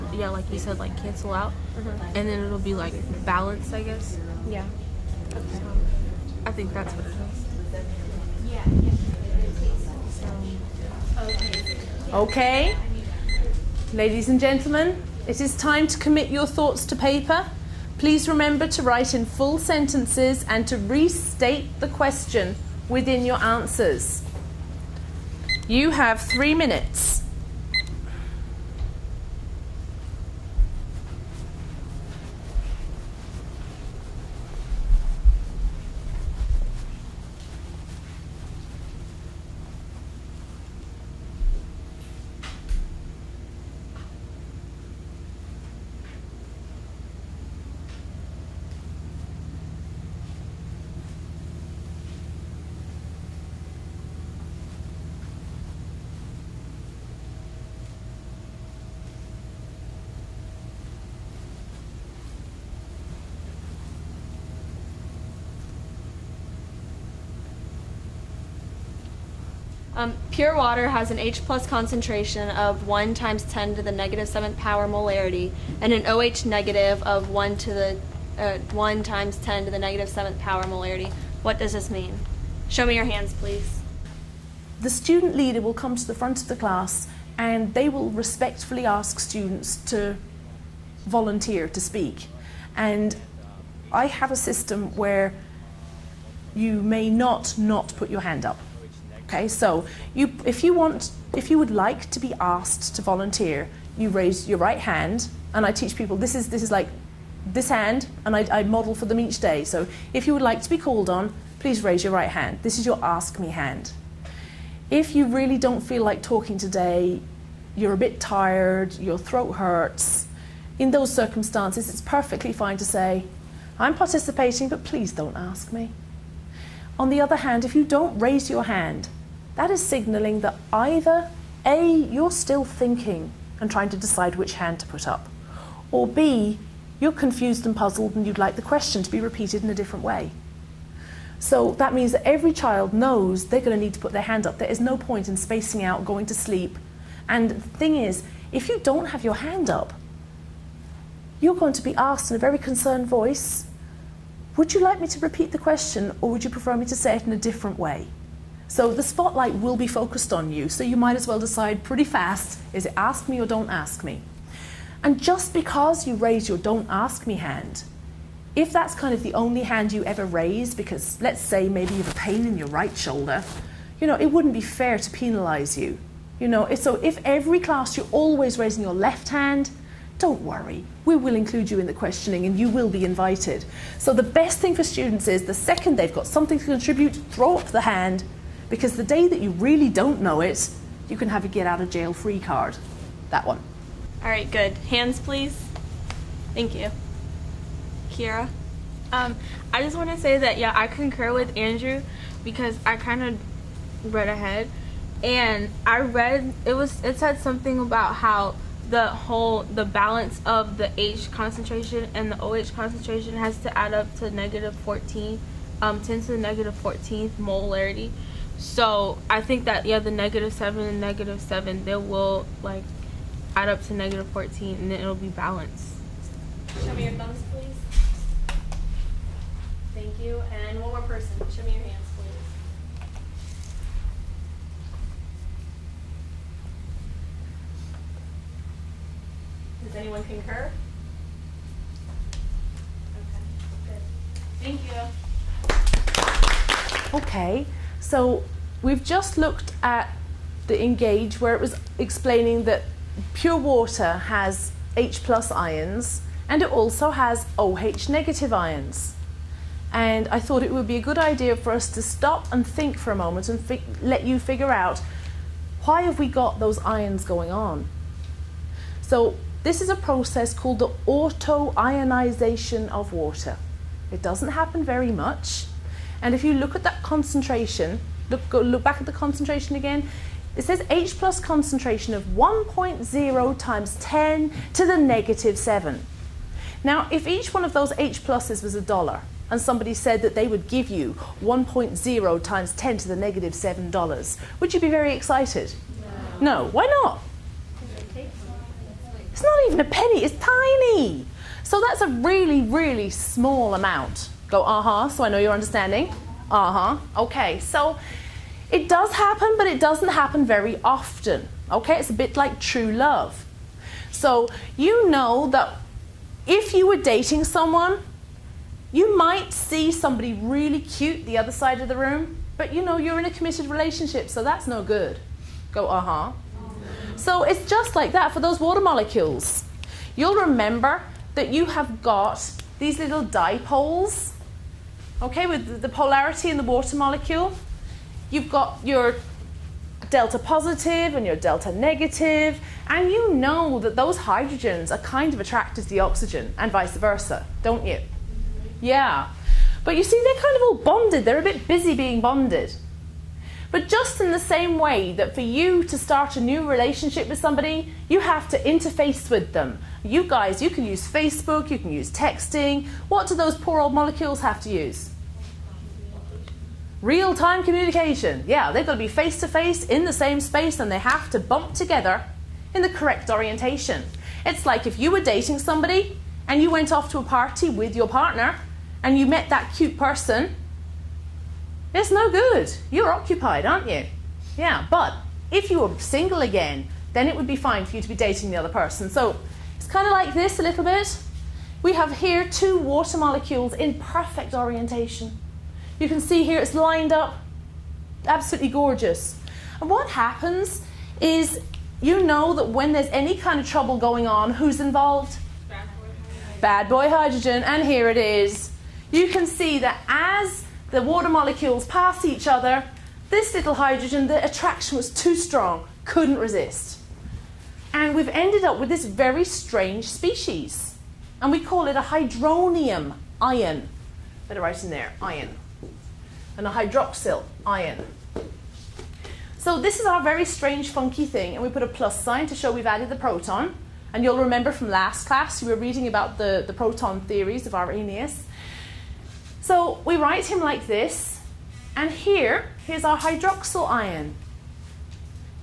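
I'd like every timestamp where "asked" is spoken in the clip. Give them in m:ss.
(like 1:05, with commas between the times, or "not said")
1:42, 2:31.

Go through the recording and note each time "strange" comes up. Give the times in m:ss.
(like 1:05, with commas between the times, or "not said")
6:59, 7:10.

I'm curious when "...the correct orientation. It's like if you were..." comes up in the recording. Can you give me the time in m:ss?
6:12.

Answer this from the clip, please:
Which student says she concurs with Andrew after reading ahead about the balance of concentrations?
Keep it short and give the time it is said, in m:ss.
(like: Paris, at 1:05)
Kira, at 3:18.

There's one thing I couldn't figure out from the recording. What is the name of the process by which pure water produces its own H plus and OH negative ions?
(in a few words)
auto-ionization of water.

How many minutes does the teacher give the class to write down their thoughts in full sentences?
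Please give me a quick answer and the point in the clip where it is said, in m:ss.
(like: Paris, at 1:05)
3, at 0:26.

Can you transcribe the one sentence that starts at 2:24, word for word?
There is no point in spacing out, going to sleep.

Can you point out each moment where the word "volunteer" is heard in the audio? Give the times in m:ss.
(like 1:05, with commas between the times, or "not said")
1:31, 1:43.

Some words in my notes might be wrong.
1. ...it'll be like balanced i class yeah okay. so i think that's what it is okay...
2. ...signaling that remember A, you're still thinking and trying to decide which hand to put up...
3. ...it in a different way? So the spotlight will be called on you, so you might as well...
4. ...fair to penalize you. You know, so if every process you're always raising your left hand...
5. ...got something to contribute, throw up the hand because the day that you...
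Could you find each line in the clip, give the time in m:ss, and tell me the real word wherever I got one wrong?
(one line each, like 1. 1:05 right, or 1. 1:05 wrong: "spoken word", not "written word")
1. 0:02 wrong: "guess", not "class"
2. 2:09 wrong: "either", not "remember"
3. 2:37 wrong: "focused", not "called"
4. 2:54 wrong: "class", not "process"
5. 3:06 right.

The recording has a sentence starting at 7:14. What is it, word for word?
And you'll remember from last class, we were reading about the, the proton theories of Arrhenius.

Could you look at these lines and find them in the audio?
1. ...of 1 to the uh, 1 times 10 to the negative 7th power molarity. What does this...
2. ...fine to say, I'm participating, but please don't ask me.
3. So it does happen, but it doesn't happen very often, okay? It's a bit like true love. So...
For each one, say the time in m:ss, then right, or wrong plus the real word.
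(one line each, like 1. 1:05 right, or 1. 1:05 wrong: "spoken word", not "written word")
1. 1:17 right
2. 2:02 right
3. 5:07 right.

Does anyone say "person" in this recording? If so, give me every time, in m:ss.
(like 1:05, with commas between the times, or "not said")
3:51, 6:19, 6:28.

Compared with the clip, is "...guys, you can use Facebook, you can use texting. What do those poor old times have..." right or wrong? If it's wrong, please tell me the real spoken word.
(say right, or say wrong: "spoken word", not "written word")
wrong: "molecules", not "times".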